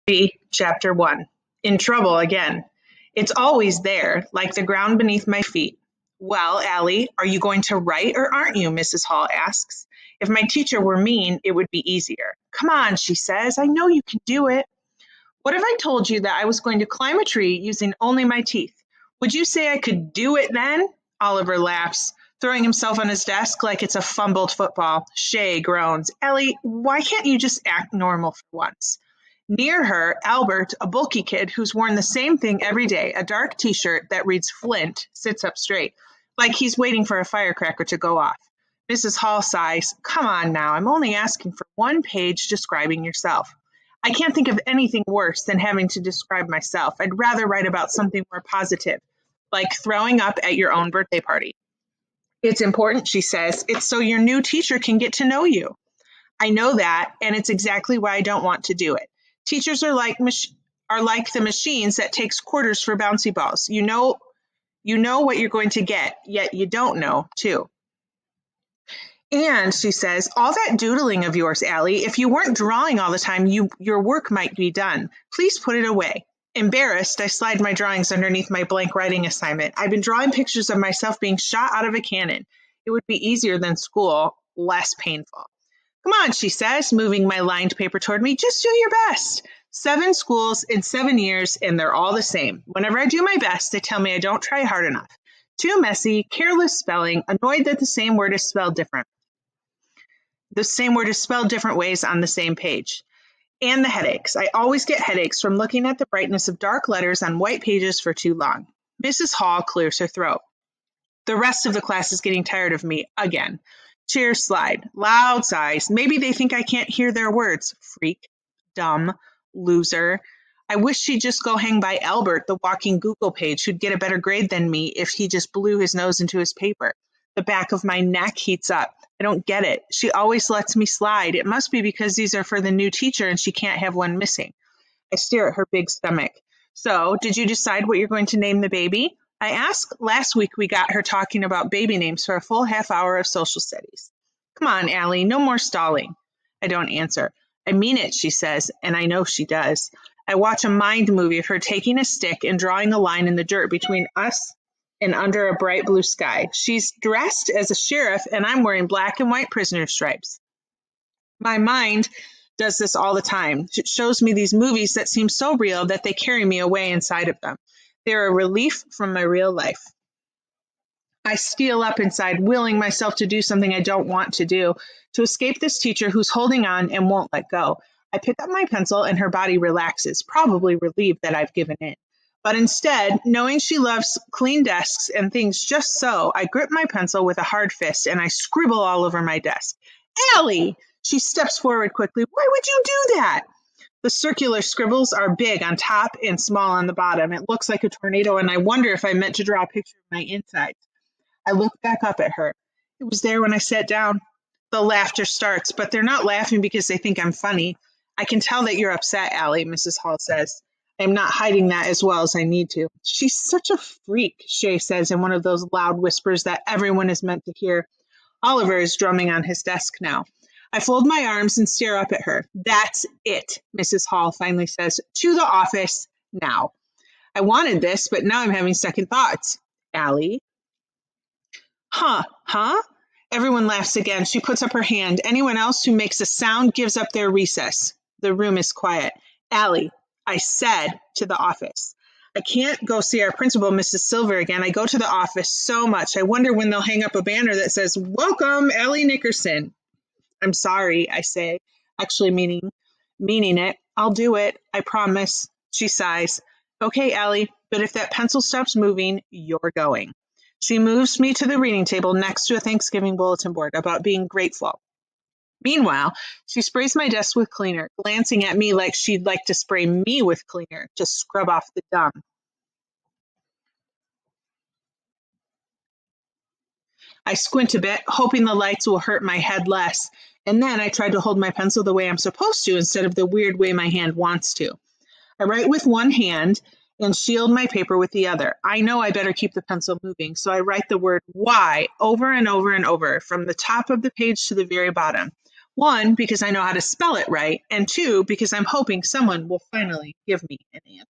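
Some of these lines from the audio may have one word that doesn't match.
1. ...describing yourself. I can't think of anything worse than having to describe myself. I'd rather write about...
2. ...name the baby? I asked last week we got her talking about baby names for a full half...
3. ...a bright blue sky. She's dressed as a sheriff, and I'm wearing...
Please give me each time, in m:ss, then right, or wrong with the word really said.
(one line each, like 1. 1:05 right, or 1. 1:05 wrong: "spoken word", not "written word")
1. 0:42 right
2. 2:18 right
3. 2:35 right.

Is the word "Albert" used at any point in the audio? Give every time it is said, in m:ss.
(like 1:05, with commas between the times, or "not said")
0:30, 2:01.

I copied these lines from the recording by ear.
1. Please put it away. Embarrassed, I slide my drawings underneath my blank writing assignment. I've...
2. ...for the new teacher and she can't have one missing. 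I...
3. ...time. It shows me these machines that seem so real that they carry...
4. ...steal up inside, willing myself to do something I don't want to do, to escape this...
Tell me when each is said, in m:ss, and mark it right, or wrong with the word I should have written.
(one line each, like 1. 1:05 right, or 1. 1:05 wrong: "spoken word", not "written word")
1. 1:15 right
2. 2:12 right
3. 2:43 wrong: "movies", not "machines"
4. 2:51 right.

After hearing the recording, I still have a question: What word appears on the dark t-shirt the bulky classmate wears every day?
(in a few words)
Flint.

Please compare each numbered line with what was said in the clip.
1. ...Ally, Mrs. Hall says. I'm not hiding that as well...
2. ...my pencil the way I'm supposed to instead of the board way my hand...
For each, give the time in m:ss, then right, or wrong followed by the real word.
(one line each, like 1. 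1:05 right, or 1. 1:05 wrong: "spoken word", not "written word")
1. 3:29 right
2. 4:41 wrong: "weird", not "board".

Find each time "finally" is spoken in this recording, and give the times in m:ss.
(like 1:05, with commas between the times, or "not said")
3:44, 4:59.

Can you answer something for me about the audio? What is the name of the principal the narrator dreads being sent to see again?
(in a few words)
Mrs. Silver.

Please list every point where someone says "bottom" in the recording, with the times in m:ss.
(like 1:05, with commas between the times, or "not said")
3:16, 4:54.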